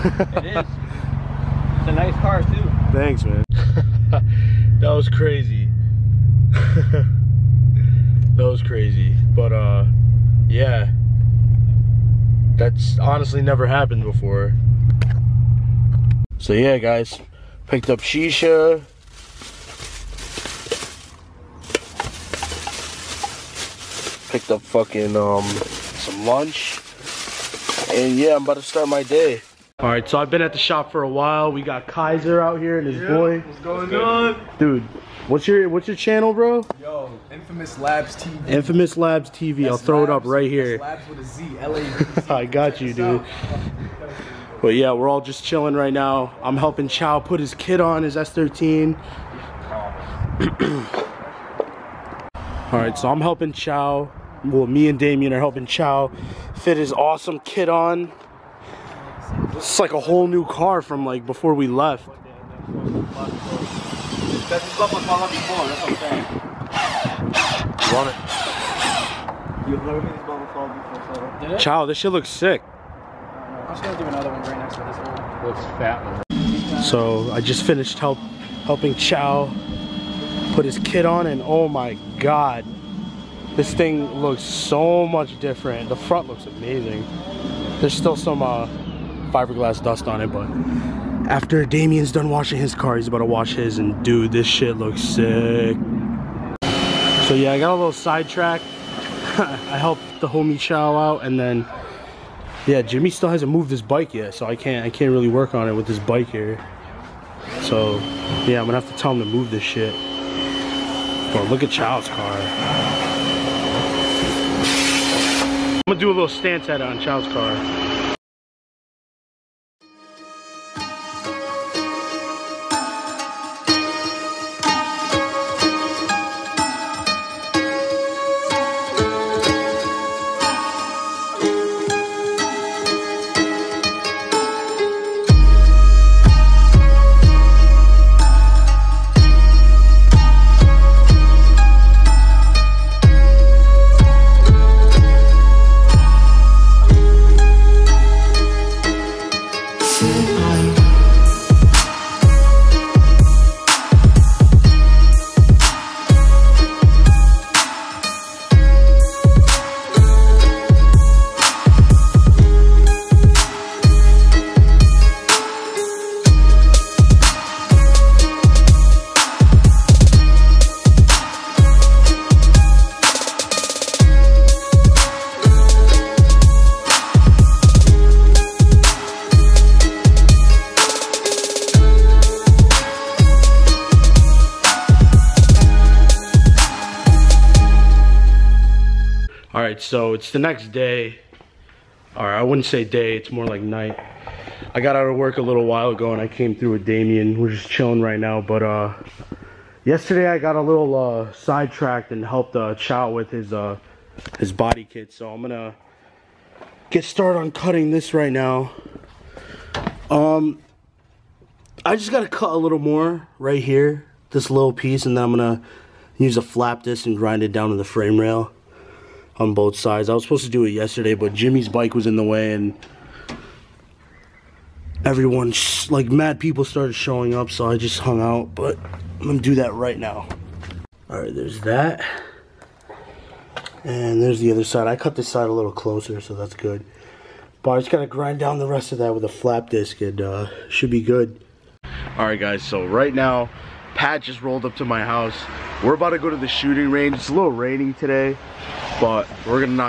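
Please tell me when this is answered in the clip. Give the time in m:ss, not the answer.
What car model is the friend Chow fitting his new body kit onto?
0:48.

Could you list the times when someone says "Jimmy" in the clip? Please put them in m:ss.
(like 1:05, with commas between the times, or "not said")
1:42, 3:41.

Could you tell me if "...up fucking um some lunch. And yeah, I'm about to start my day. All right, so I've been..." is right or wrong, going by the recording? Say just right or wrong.
right.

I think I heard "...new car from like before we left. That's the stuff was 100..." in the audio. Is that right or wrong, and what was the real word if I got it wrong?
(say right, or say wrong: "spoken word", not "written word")
right.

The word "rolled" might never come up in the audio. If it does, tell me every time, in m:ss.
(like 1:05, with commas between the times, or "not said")
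4:04.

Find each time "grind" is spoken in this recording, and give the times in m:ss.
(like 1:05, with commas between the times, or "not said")
3:37, 3:58.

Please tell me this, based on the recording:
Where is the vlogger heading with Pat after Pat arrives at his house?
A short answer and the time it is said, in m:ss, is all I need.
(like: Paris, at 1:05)
the shooting range, at 4:06.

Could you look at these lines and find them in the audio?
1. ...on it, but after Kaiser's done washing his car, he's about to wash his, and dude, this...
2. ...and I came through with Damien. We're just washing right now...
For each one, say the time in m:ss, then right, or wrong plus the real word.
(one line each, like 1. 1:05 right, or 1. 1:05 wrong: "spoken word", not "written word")
1. 1:30 wrong: "Damien", not "Kaiser"
2. 3:16 wrong: "chilling", not "washing".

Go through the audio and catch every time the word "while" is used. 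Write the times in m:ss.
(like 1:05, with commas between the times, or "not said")
0:31, 3:15.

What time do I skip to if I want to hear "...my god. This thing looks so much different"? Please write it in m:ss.
1:21.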